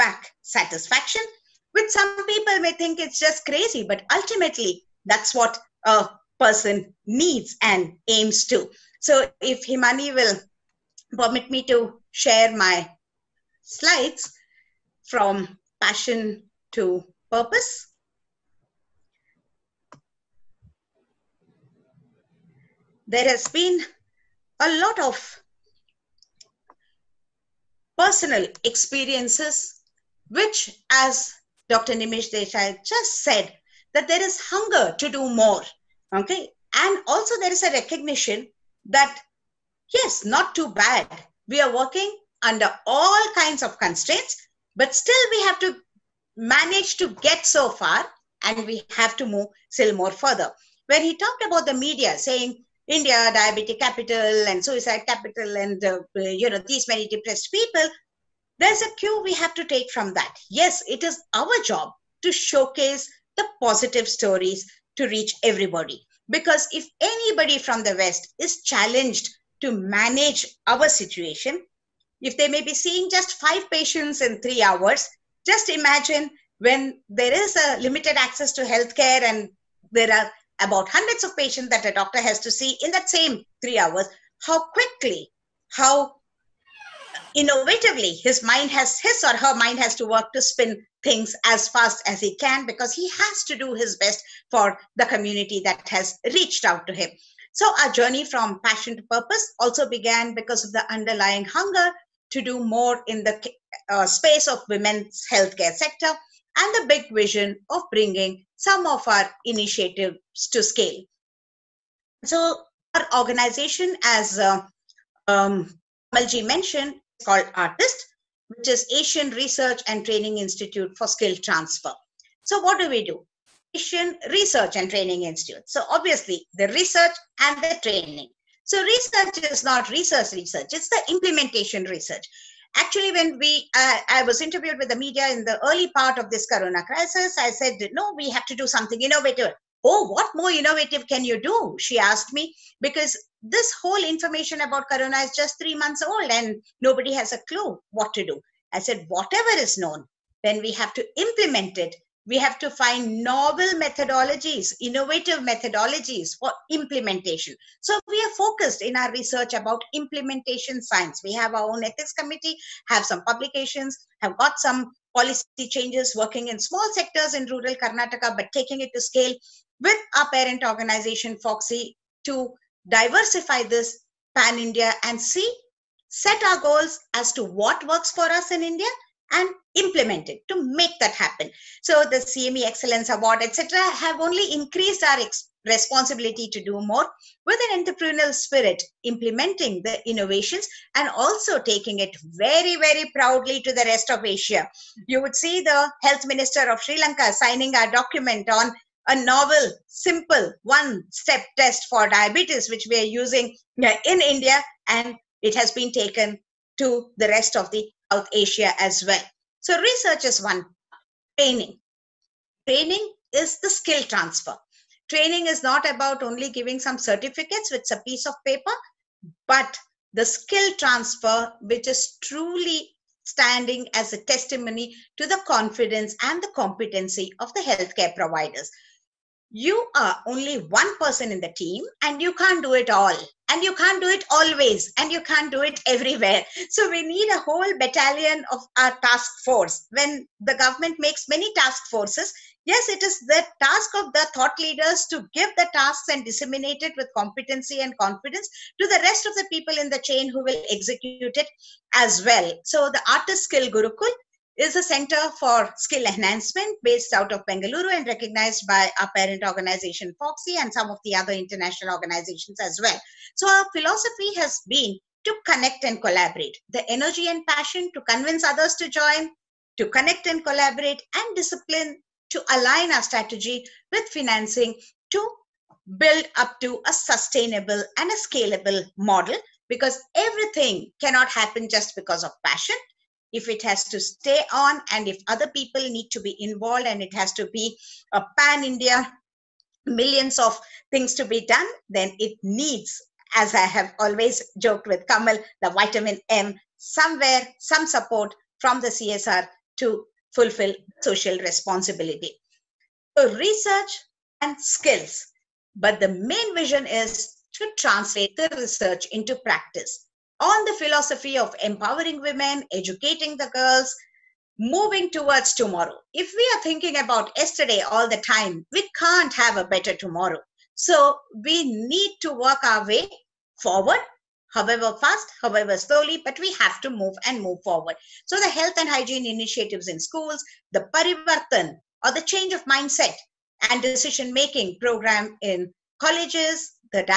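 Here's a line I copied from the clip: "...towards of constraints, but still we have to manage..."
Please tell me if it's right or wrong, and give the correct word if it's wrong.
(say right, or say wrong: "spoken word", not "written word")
wrong: "kinds", not "towards".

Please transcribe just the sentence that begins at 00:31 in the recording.
Nimish Desai just said, that there is hunger to do more.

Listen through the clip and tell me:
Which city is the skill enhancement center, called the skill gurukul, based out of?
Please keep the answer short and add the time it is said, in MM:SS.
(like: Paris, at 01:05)
Bengaluru, at 04:17.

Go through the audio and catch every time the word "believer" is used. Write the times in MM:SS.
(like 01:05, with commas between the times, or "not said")
not said.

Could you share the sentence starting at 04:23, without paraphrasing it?
So our philosophy has been to connect and collaborate.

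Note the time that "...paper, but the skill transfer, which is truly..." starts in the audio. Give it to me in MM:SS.
03:38.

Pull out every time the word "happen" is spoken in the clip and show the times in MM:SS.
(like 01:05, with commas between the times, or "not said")
03:01, 04:41.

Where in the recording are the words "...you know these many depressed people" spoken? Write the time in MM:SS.
00:56.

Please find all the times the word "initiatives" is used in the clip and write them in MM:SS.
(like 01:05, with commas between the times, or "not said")
01:49, 05:29.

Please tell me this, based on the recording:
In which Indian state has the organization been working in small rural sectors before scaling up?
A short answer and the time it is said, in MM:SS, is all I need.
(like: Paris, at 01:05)
Karnataka, at 02:47.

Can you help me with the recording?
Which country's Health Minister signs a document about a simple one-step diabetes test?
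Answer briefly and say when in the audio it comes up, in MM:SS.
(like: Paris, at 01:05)
Sri Lanka, at 03:16.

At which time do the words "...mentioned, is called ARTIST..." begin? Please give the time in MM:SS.
01:56.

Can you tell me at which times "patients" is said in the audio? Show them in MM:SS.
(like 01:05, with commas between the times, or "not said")
01:13, 01:21.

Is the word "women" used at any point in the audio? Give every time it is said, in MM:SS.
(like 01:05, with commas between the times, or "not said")
01:44, 05:12.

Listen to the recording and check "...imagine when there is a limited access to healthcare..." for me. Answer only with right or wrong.
right.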